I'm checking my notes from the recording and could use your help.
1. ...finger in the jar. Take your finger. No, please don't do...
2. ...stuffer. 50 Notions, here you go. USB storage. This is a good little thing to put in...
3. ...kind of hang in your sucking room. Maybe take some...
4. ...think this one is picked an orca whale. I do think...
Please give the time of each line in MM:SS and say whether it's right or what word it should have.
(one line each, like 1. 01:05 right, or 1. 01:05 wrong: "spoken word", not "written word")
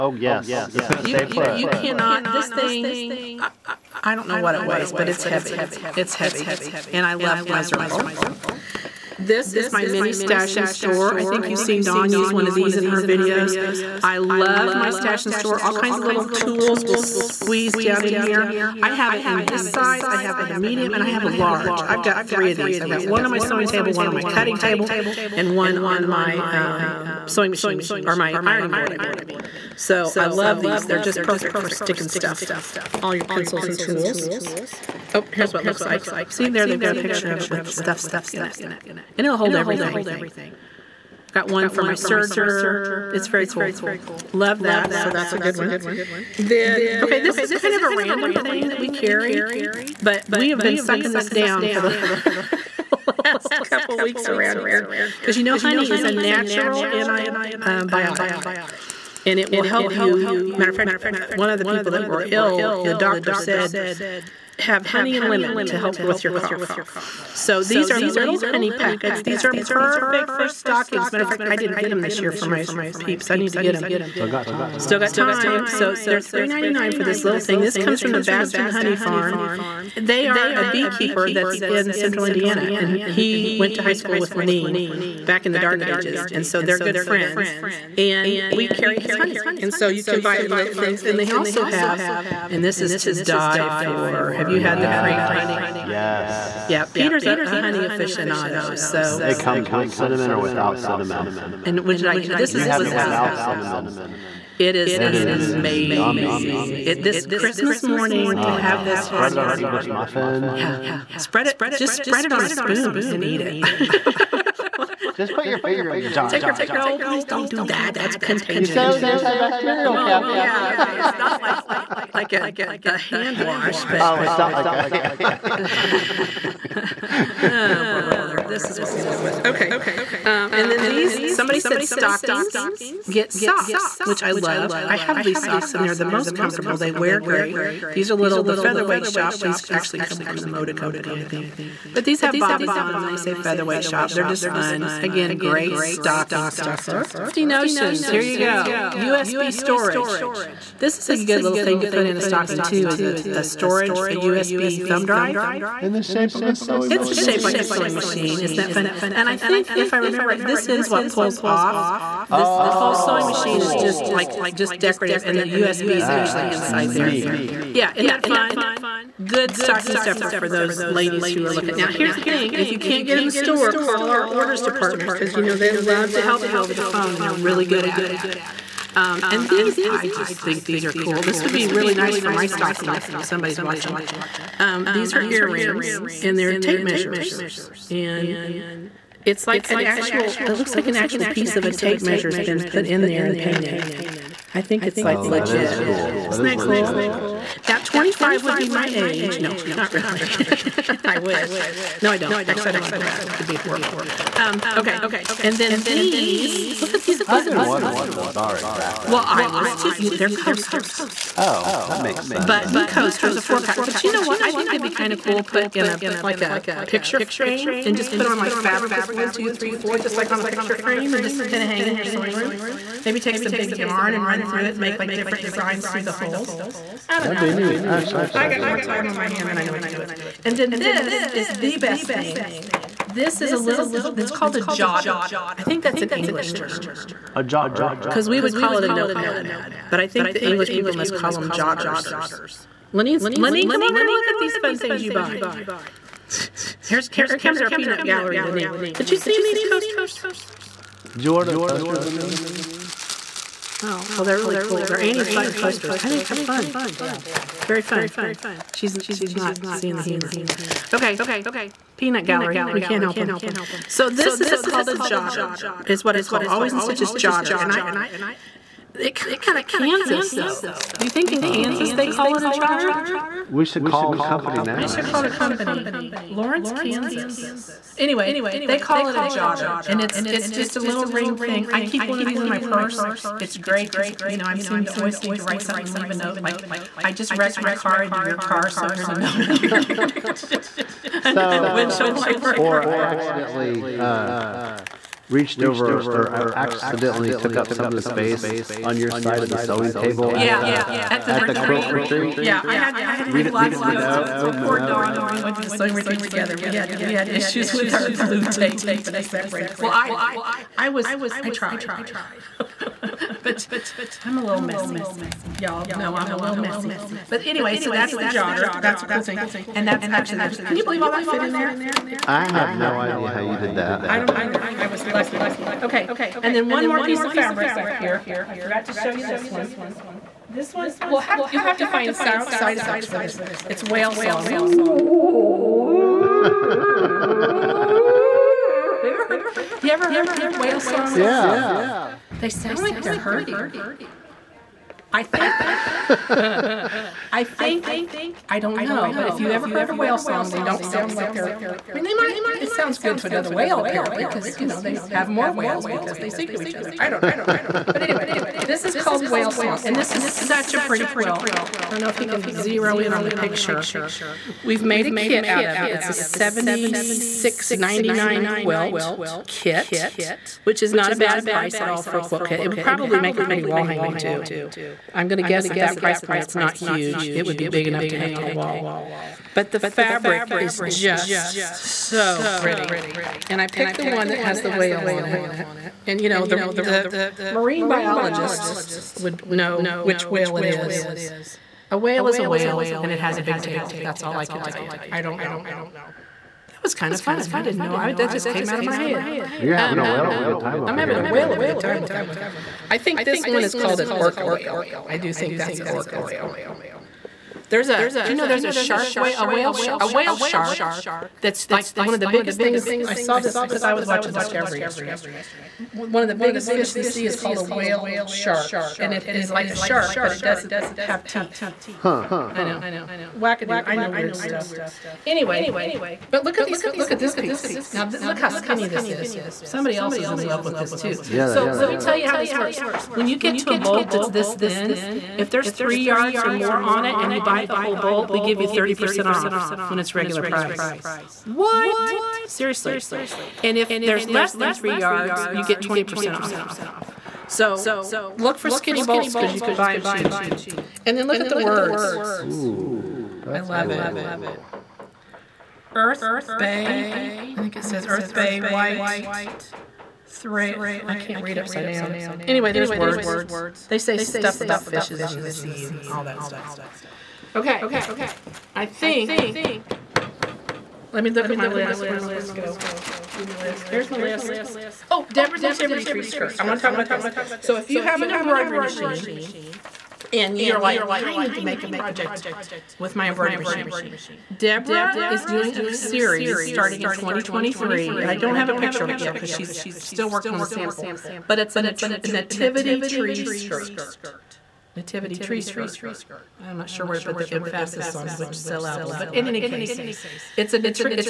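1. 01:55 right
2. 02:26 right
3. 03:41 wrong: "sewing", not "sucking"
4. 06:42 wrong: "called", not "picked".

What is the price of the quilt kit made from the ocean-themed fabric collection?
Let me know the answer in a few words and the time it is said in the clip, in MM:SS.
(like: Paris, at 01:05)
$76.99, at 06:06.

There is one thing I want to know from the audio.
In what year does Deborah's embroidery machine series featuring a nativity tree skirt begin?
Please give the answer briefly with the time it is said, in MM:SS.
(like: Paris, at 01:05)
2023, at 08:07.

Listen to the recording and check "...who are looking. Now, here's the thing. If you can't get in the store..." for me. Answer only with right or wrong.
right.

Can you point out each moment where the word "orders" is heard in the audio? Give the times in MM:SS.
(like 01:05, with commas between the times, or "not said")
02:54, 04:11.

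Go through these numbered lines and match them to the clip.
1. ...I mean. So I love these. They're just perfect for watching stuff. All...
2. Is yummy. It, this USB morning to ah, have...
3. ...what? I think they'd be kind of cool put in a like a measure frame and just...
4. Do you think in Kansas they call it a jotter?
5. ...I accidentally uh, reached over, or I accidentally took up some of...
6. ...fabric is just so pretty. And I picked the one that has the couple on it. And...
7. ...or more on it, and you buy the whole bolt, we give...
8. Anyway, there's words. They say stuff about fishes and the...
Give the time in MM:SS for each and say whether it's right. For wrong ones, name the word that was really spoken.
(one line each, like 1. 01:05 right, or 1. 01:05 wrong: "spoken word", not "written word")
1. 00:28 wrong: "sticking", not "watching"
2. 01:46 wrong: "Christmas", not "USB"
3. 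03:34 wrong: "picture", not "measure"
4. 04:30 right
5. 04:52 right
6. 06:19 wrong: "whale", not "couple"
7. 07:16 right
8. 07:42 right.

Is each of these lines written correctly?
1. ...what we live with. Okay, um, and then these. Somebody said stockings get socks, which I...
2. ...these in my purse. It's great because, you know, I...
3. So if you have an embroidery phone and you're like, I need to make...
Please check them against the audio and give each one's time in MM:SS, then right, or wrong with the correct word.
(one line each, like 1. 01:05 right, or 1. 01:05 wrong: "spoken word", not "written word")
1. 02:08 right
2. 04:42 right
3. 07:57 wrong: "machine", not "phone".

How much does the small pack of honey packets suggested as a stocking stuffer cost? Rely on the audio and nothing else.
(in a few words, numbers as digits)
$3.99.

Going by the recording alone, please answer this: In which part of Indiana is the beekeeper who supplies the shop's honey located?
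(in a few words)
Central Indiana.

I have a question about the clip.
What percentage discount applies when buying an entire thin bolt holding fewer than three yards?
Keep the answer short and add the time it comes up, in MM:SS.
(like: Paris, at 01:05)
20%, at 07:25.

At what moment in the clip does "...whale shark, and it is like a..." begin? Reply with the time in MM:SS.
06:57.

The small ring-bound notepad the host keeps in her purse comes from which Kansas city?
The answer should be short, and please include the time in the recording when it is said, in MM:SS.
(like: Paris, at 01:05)
Lawrence, at 04:36.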